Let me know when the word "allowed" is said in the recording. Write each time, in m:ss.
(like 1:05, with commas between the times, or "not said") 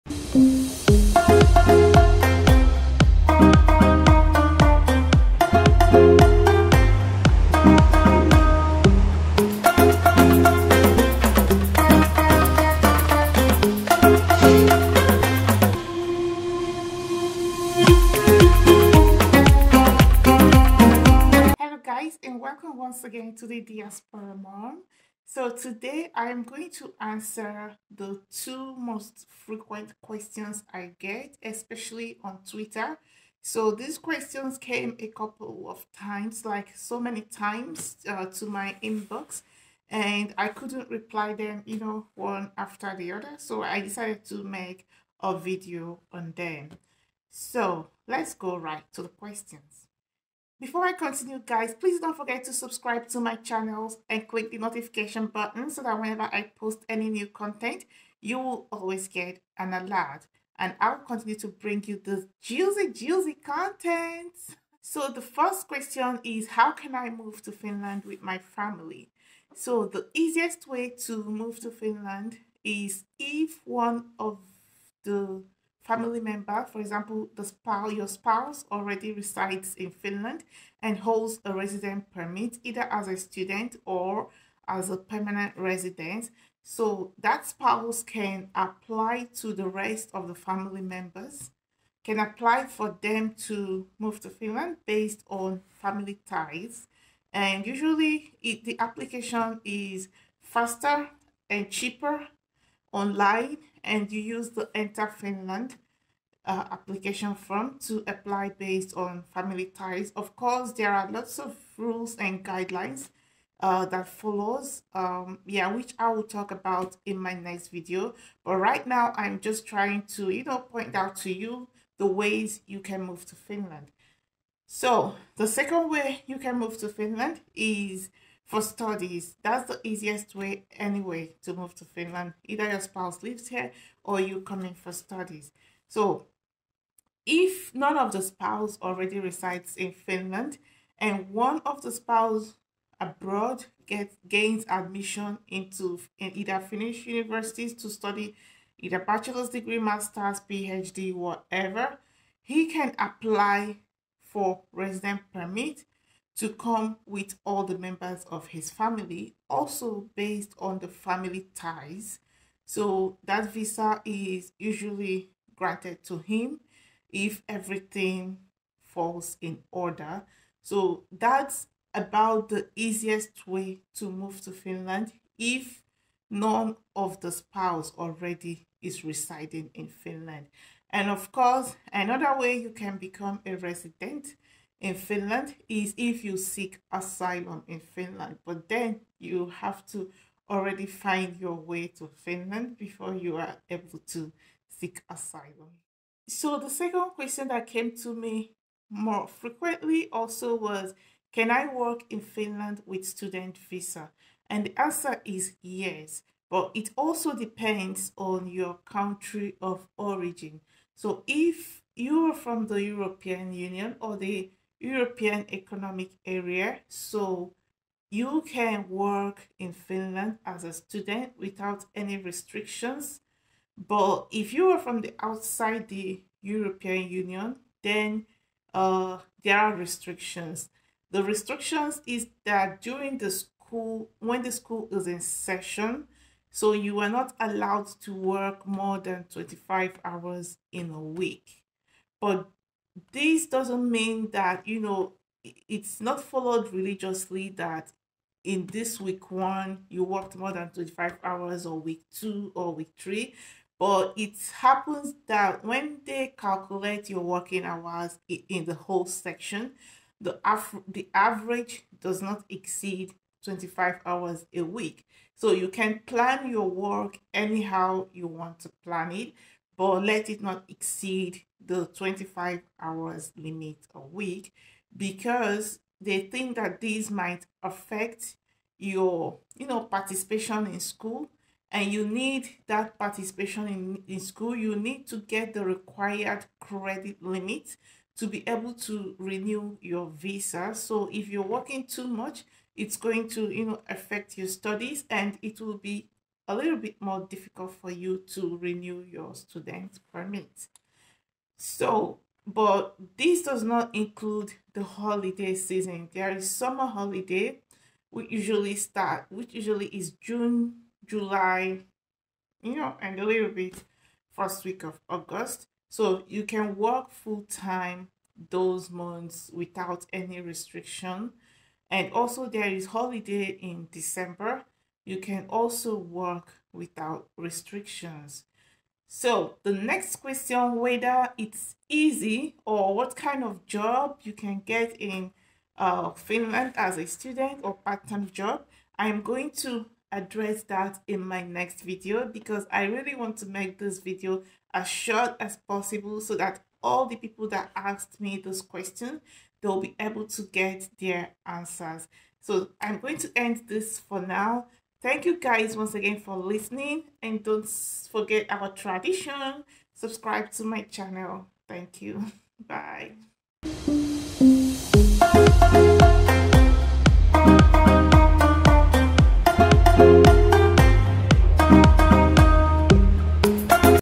3:57.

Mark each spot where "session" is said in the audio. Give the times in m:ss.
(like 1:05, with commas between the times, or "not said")
3:55.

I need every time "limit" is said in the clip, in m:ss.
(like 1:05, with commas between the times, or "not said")
4:33, 4:47.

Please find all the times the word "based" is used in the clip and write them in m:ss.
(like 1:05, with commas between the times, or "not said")
1:34, 1:48, 2:40.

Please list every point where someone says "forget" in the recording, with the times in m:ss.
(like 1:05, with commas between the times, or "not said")
0:52, 5:58.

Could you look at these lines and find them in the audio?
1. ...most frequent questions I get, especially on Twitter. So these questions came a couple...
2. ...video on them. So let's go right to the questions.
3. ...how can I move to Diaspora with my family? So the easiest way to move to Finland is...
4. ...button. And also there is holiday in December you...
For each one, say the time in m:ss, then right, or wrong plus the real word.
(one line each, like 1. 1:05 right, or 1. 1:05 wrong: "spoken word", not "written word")
1. 0:28 right
2. 0:45 right
3. 1:06 wrong: "Finland", not "Diaspora"
4. 5:20 wrong: "restriction", not "button".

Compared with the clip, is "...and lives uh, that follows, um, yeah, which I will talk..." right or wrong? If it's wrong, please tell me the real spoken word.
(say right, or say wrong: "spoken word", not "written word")
wrong: "guidelines", not "lives".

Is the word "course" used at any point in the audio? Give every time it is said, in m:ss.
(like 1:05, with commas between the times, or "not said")
1:50, 3:01.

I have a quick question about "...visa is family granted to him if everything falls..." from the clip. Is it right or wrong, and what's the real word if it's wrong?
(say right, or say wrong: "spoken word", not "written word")
wrong: "usually", not "family".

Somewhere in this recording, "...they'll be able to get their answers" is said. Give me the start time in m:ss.
5:49.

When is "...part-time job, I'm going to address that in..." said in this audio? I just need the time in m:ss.
5:37.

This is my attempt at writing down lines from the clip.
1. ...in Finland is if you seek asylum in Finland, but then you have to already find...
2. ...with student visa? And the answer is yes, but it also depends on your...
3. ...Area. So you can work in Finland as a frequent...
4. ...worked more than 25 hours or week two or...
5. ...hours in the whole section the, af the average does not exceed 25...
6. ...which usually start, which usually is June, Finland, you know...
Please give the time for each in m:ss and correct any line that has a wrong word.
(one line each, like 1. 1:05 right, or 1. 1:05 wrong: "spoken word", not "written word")
1. 3:04 right
2. 3:22 right
3. 3:36 wrong: "student", not "frequent"
4. 4:10 right
5. 4:17 right
6. 5:08 wrong: "July", not "Finland".